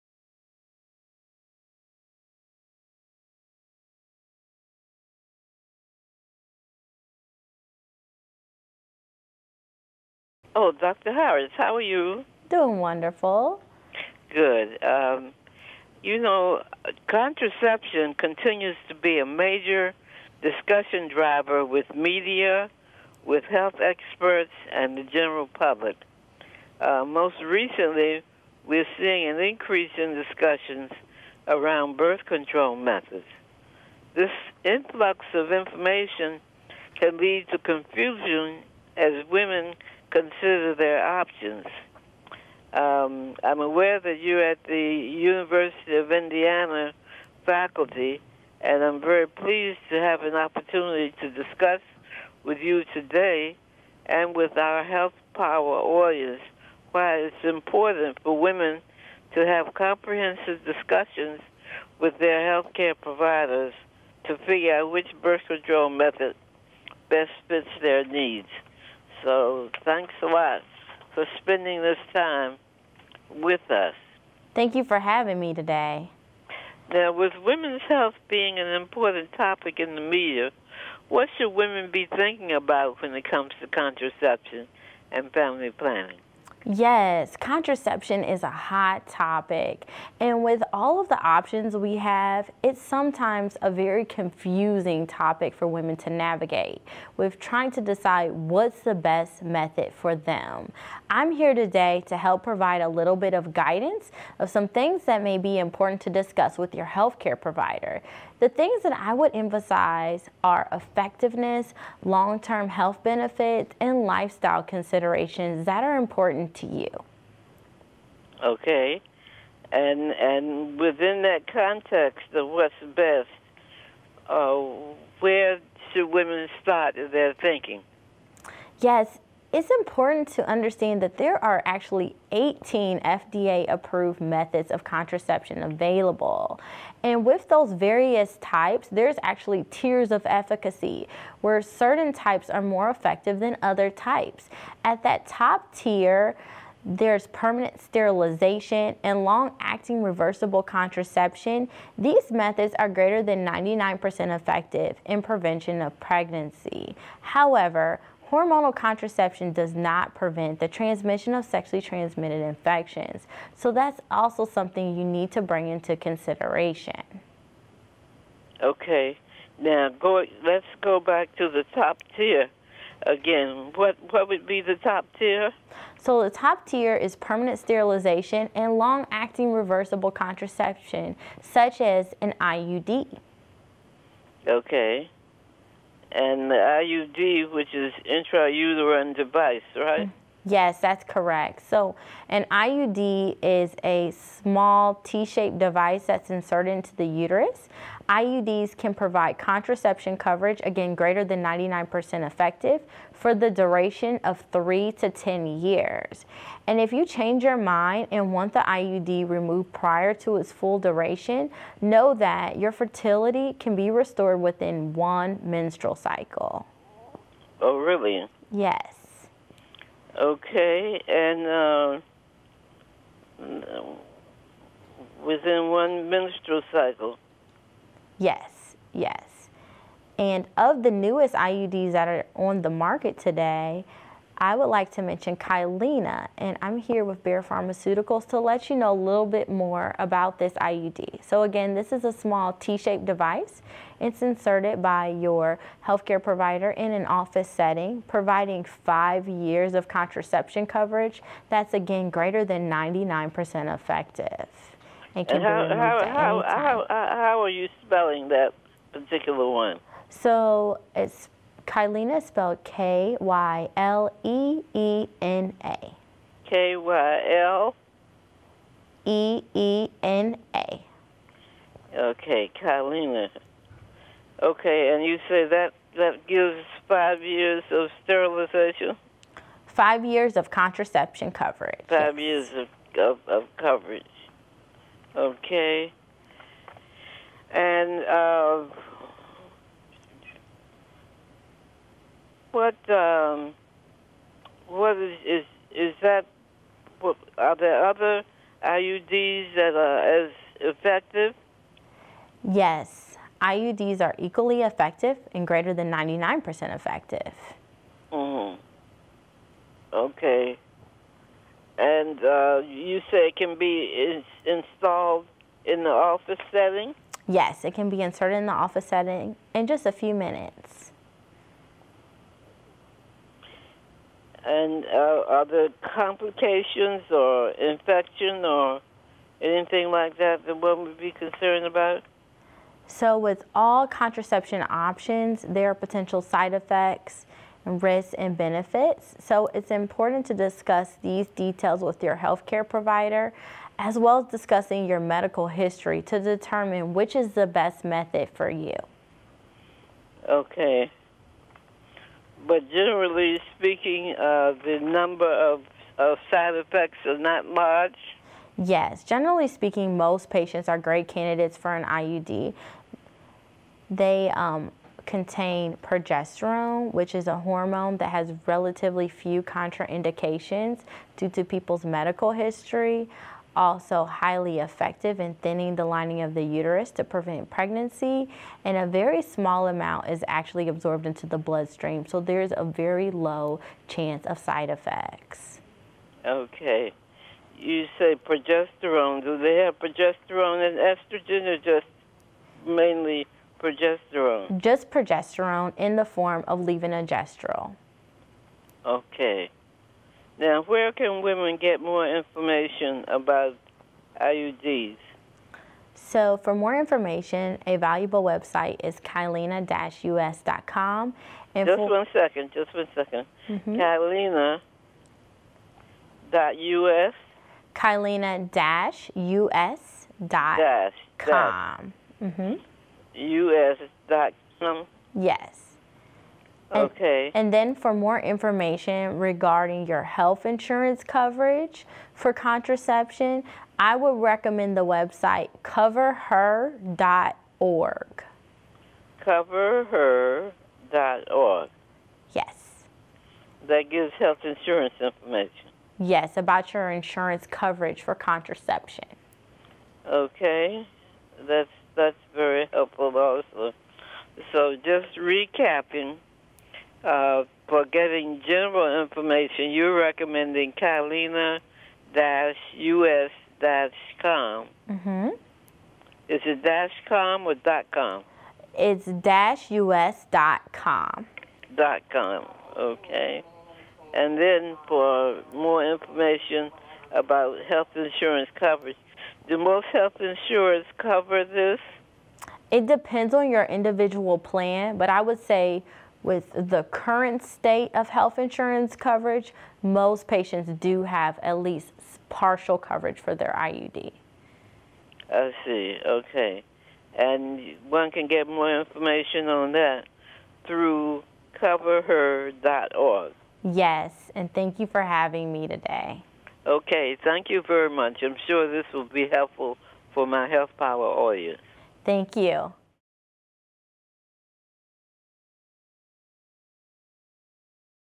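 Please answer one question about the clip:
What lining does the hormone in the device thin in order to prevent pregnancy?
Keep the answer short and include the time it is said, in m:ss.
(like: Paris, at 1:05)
lining of the uterus, at 6:15.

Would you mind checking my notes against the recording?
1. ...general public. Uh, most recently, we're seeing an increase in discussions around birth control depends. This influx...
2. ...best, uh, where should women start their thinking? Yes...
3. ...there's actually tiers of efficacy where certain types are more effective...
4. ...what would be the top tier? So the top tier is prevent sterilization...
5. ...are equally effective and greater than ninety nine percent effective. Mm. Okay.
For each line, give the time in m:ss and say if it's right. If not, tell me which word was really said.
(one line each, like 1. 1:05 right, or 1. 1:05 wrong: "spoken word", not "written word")
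1. 0:25 wrong: "methods", not "depends"
2. 2:02 right
3. 2:18 right
4. 2:54 wrong: "permanent", not "prevent"
5. 5:04 right.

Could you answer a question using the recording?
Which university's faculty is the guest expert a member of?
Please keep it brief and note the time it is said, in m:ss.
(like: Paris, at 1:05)
University of Indiana, at 0:44.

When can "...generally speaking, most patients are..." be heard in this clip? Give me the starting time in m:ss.
5:59.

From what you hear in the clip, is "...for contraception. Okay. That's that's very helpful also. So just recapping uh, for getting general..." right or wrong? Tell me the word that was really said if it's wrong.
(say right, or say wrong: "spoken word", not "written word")
right.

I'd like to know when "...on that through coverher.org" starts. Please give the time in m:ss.
8:19.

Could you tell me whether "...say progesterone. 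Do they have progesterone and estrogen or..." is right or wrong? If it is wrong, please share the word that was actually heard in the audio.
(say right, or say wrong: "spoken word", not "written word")
right.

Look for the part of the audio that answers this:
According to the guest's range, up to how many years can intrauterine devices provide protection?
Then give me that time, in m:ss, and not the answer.
3:25.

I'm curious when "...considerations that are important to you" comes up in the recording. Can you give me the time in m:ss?
1:54.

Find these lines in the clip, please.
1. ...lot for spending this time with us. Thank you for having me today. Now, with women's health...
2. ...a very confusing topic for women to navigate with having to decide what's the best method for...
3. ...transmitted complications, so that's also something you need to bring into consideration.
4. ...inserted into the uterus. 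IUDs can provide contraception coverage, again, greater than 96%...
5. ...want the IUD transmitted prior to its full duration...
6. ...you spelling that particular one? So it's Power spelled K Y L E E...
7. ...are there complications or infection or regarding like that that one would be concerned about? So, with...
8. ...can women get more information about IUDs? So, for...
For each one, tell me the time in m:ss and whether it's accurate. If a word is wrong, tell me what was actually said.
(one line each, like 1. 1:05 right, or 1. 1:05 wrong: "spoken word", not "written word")
1. 1:10 right
2. 1:33 wrong: "trying", not "having"
3. 2:41 wrong: "infections", not "complications"
4. 3:16 wrong: "99", not "96"
5. 3:28 wrong: "removed", not "transmitted"
6. 4:17 wrong: "Kyleena", not "Power"
7. 5:25 wrong: "anything", not "regarding"
8. 6:40 right.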